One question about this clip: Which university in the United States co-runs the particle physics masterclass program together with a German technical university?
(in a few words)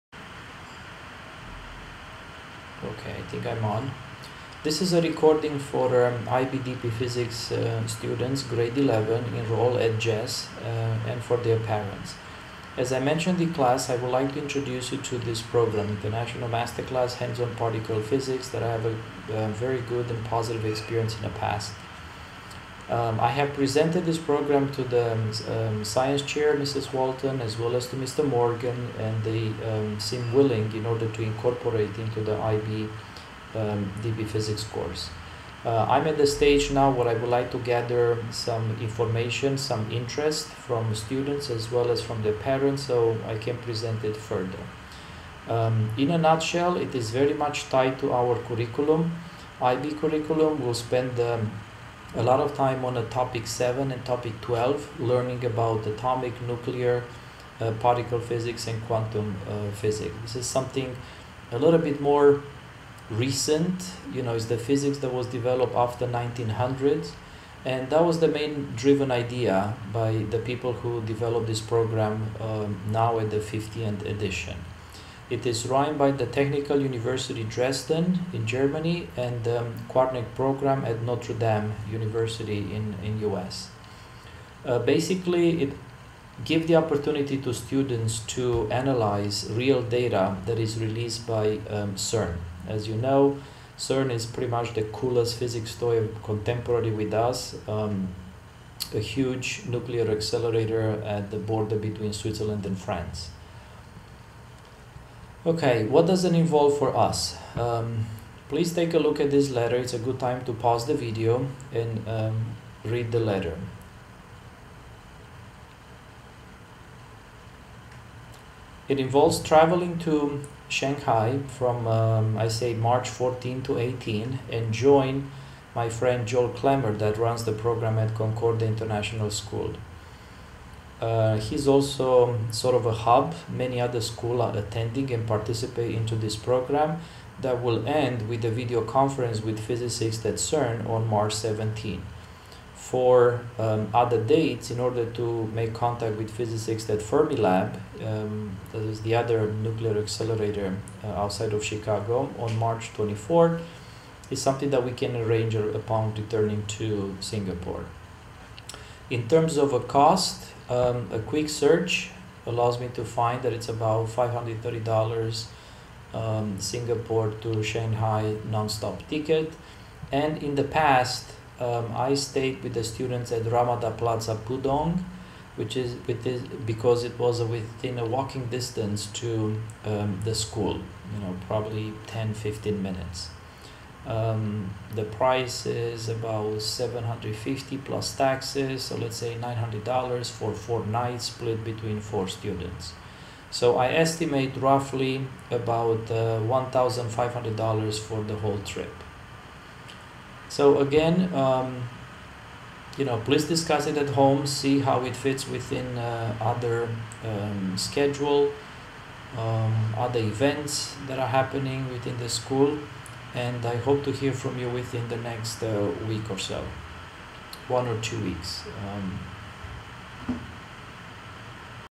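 Notre Dame University.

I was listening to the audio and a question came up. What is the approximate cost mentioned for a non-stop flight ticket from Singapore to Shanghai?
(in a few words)
$530.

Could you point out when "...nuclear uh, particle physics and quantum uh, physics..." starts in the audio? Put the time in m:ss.
0:56.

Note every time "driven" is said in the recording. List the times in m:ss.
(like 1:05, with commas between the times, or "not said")
1:08.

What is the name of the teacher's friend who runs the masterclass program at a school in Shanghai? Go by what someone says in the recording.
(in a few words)
Joel Clemmer.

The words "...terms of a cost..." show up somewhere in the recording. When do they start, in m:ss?
2:39.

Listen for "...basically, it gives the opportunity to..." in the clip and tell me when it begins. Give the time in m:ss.
1:24.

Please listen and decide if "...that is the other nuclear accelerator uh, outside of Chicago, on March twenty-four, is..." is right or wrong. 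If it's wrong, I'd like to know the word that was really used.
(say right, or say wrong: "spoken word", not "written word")
right.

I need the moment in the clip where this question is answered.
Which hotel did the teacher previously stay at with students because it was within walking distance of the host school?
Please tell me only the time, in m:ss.
2:53.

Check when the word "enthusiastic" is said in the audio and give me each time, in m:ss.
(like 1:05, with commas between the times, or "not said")
not said.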